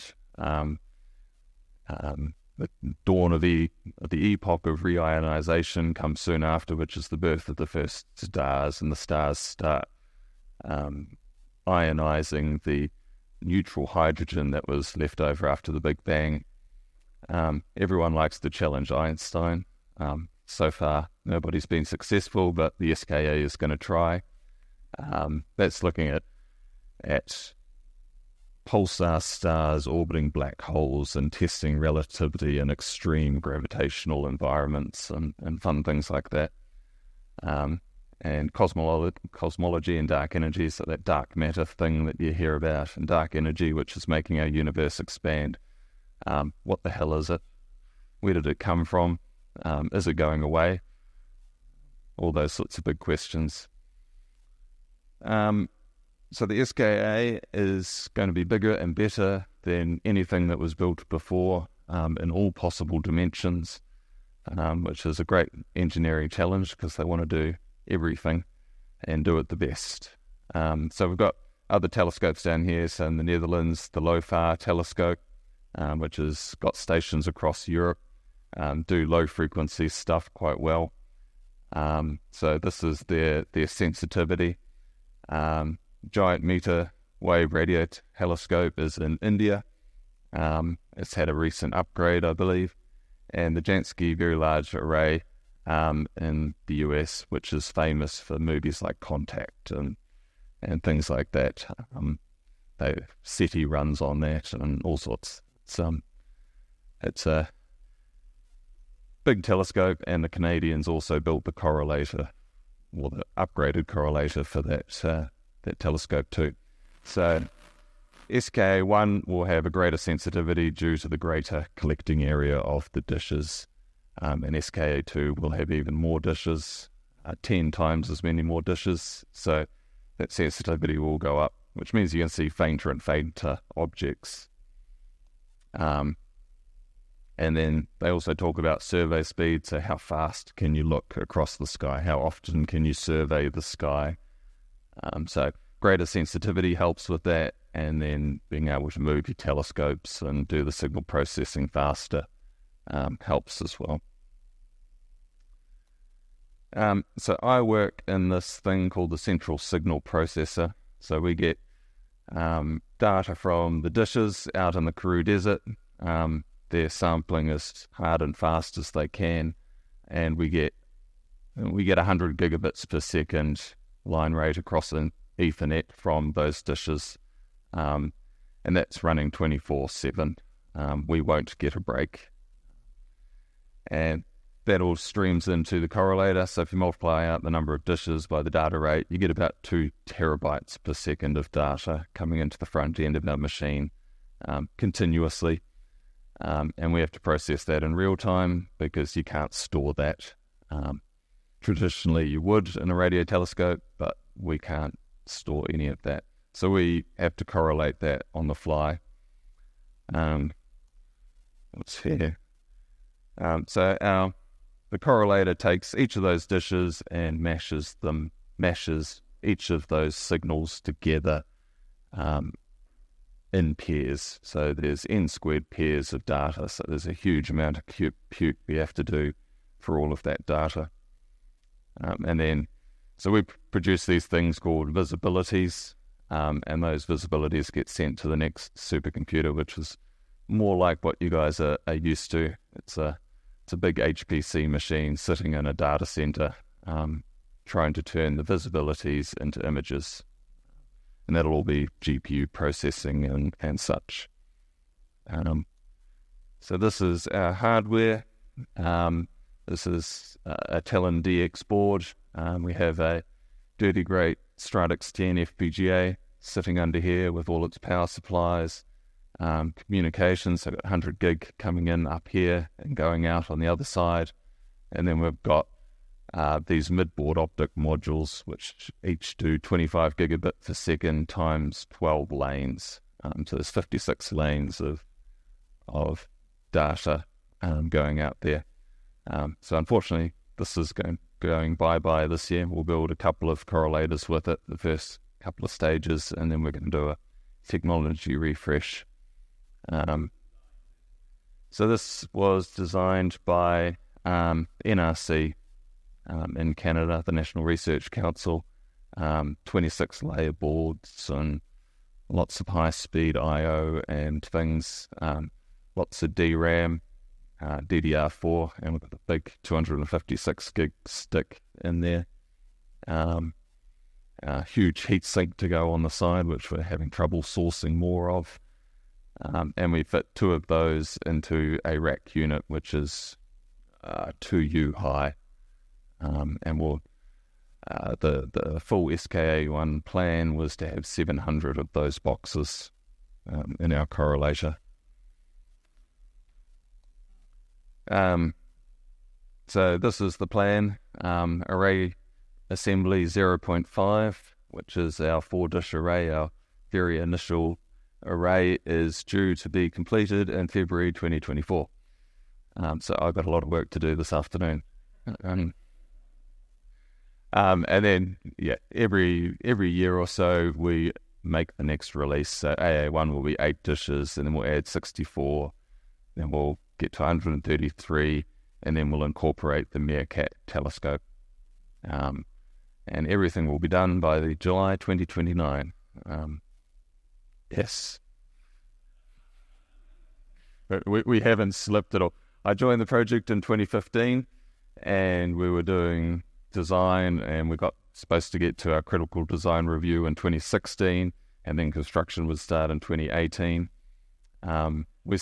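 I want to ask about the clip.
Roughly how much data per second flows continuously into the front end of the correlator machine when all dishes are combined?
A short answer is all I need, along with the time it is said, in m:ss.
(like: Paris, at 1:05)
2 terabytes, at 3:09.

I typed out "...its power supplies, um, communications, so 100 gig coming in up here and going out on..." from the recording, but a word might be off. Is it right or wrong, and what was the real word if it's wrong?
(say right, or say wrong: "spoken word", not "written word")
right.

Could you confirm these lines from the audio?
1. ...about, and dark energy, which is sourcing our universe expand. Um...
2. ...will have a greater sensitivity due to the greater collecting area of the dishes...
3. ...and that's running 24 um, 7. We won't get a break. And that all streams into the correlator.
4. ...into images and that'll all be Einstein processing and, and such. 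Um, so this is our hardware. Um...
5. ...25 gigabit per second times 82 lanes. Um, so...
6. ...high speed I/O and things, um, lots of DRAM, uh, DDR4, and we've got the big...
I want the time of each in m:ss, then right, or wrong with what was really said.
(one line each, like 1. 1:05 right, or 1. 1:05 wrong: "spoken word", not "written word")
1. 0:42 wrong: "making", not "sourcing"
2. 1:59 right
3. 2:58 right
4. 4:09 wrong: "GPU", not "Einstein"
5. 4:39 wrong: "12", not "82"
6. 5:12 right.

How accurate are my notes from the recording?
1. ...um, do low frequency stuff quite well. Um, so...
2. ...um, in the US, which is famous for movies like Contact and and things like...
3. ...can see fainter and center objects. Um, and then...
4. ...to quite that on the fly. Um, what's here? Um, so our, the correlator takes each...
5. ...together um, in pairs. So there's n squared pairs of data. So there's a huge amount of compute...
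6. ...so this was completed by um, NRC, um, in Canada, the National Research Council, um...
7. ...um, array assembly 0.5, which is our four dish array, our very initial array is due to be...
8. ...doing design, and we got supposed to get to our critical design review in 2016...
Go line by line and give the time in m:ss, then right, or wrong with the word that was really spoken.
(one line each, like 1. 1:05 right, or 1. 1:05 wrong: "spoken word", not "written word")
1. 1:18 right
2. 1:35 right
3. 2:12 wrong: "fainter", not "center"
4. 3:27 wrong: "correlate", not "quite"
5. 3:40 right
6. 5:01 wrong: "designed", not "completed"
7. 5:51 right
8. 6:35 right.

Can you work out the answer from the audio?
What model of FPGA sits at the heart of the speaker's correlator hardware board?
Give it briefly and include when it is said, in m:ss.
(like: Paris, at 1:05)
Stratix 10, at 4:24.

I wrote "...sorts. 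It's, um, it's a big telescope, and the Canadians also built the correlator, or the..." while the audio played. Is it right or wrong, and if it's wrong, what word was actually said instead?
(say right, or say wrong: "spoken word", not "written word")
right.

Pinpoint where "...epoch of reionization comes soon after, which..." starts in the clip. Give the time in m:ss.
0:04.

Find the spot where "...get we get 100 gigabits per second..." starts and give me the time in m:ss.
2:50.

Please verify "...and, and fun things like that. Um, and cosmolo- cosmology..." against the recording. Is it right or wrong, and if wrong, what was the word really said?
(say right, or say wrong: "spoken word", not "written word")
right.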